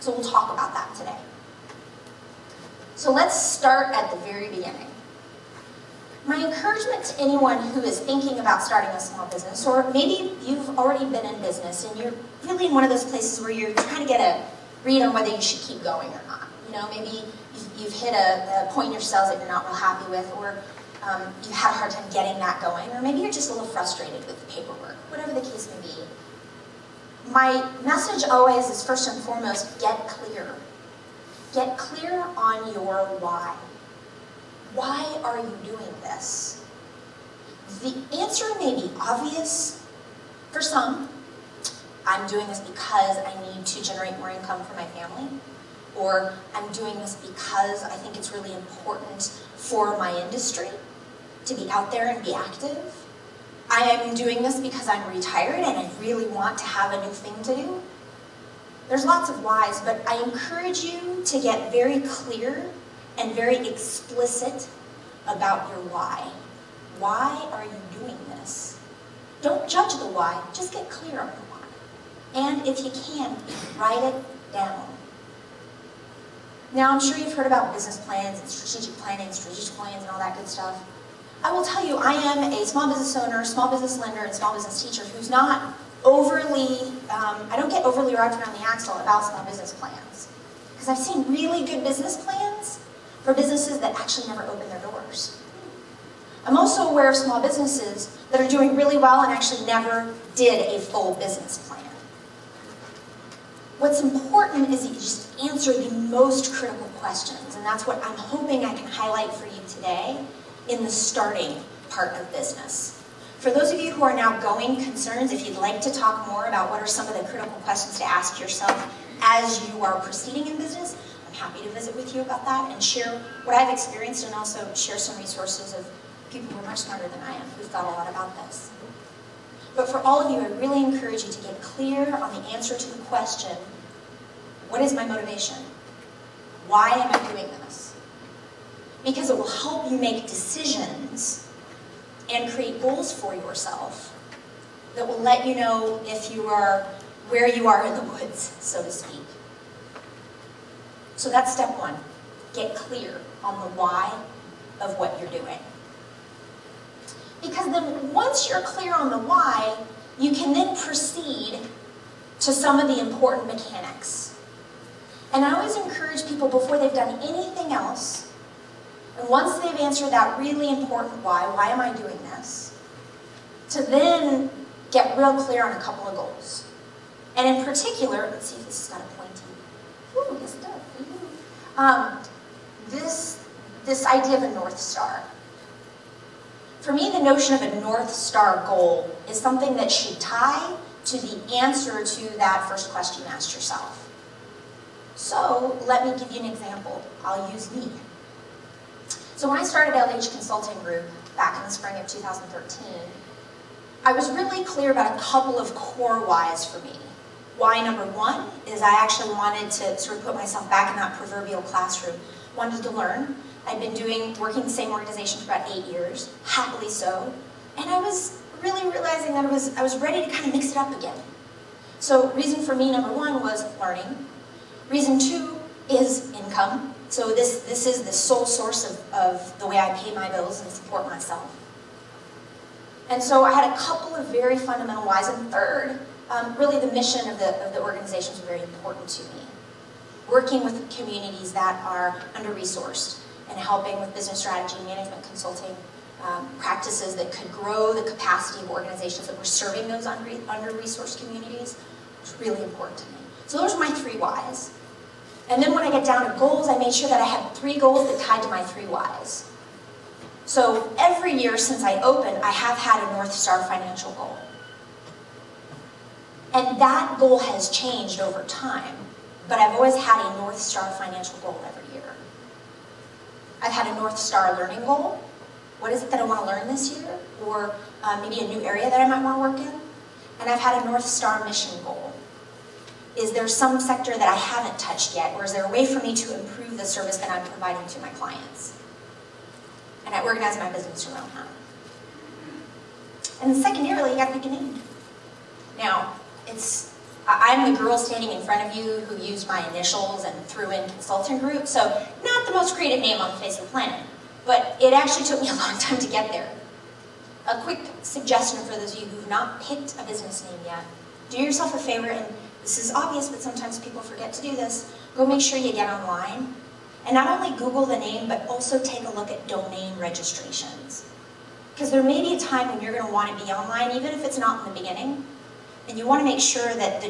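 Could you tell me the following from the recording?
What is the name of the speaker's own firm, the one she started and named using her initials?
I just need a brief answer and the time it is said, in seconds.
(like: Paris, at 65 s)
LH Consulting Group, at 199 s.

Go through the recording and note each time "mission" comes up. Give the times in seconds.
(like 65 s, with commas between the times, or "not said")
236 s, 281 s.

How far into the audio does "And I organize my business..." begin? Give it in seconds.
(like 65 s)
290 s.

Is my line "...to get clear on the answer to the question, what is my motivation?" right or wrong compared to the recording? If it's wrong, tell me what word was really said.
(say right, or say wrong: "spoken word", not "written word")
right.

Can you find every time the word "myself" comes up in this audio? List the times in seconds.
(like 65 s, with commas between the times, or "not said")
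210 s, 231 s.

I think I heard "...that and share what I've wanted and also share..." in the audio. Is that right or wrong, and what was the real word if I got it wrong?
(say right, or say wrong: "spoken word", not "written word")
wrong: "experienced", not "wanted".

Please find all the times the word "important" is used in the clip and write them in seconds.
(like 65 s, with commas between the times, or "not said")
48 s, 103 s, 162 s, 170 s, 238 s, 252 s.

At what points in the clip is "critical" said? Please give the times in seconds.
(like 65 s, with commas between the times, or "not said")
106 s, 117 s.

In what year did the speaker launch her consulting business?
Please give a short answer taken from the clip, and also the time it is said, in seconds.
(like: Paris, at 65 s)
2013, at 202 s.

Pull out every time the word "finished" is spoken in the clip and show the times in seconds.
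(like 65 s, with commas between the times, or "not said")
not said.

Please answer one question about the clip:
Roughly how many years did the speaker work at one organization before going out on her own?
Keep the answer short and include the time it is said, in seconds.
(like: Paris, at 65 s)
8, at 215 s.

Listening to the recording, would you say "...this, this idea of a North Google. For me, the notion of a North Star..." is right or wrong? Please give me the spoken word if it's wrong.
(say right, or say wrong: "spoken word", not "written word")
wrong: "Star", not "Google".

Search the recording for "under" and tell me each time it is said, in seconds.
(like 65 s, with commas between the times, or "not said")
242 s, 250 s.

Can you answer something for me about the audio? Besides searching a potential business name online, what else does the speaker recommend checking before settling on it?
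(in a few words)
Domain registrations.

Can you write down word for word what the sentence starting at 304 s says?
But it actually took me a long time to get there.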